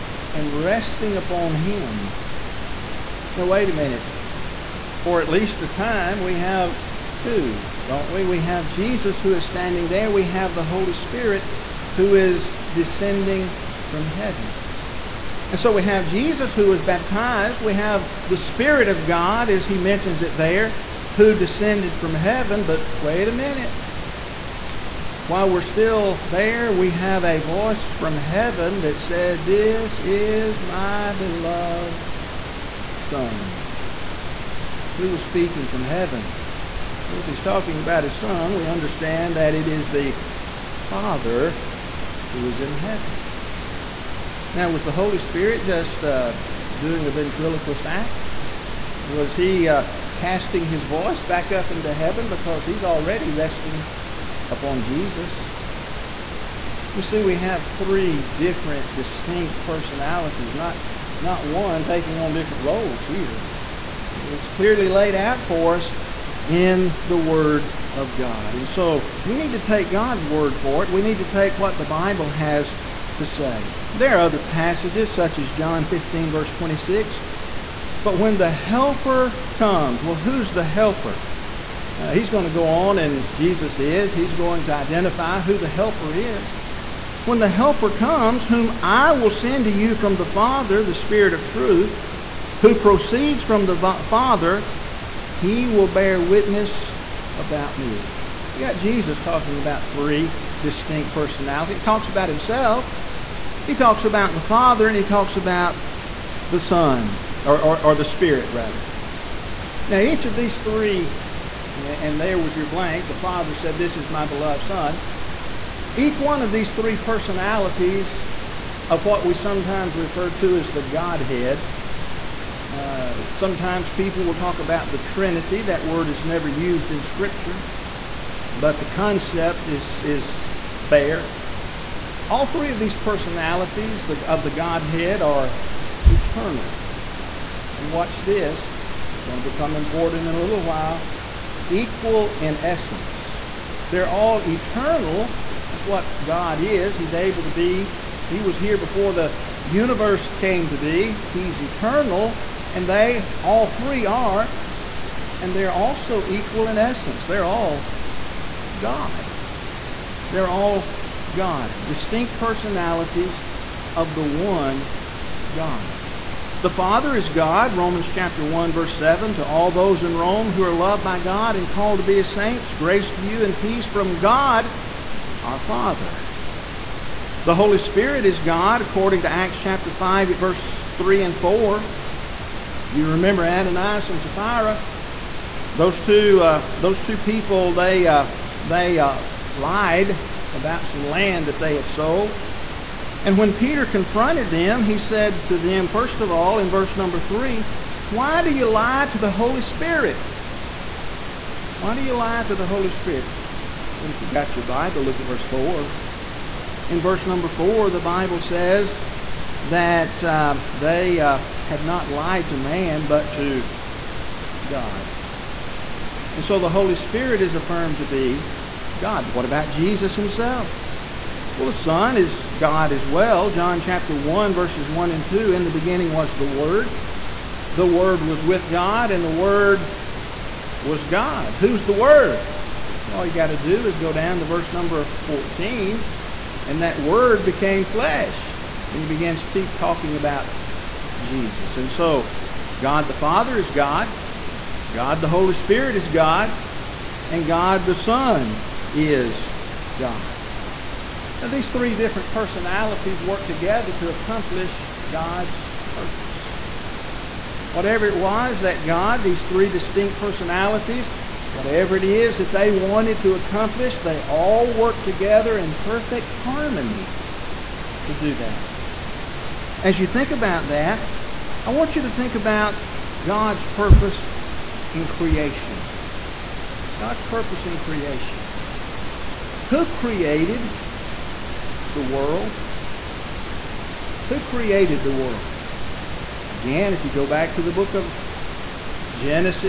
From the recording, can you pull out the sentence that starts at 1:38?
You got Jesus talking about three distinct personalities.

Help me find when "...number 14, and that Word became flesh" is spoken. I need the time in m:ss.
3:54.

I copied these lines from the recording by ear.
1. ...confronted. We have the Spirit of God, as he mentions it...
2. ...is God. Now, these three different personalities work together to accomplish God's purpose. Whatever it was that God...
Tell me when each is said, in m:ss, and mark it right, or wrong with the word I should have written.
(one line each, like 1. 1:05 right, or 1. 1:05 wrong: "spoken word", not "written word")
1. 0:16 wrong: "baptized", not "confronted"
2. 4:08 right.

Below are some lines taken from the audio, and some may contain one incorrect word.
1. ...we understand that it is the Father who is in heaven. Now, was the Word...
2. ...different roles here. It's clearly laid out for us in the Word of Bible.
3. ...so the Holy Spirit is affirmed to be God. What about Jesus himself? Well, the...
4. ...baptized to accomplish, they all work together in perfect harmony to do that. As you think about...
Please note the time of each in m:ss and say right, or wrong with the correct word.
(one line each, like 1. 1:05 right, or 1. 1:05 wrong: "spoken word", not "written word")
1. 0:38 wrong: "Holy", not "Word"
2. 1:02 wrong: "God", not "Bible"
3. 3:36 right
4. 4:22 wrong: "wanted", not "baptized".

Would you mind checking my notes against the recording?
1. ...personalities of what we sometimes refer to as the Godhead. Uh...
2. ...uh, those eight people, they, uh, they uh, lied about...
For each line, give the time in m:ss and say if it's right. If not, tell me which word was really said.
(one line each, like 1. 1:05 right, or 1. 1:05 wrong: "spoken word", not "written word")
1. 1:56 right
2. 3:06 wrong: "two", not "eight".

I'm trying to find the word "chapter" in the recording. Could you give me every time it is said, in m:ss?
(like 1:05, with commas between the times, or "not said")
2:48, 2:59, 3:43.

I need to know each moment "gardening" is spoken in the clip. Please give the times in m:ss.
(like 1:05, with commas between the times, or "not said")
not said.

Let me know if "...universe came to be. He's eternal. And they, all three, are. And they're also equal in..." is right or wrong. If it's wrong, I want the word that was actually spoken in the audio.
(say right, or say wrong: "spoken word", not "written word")
right.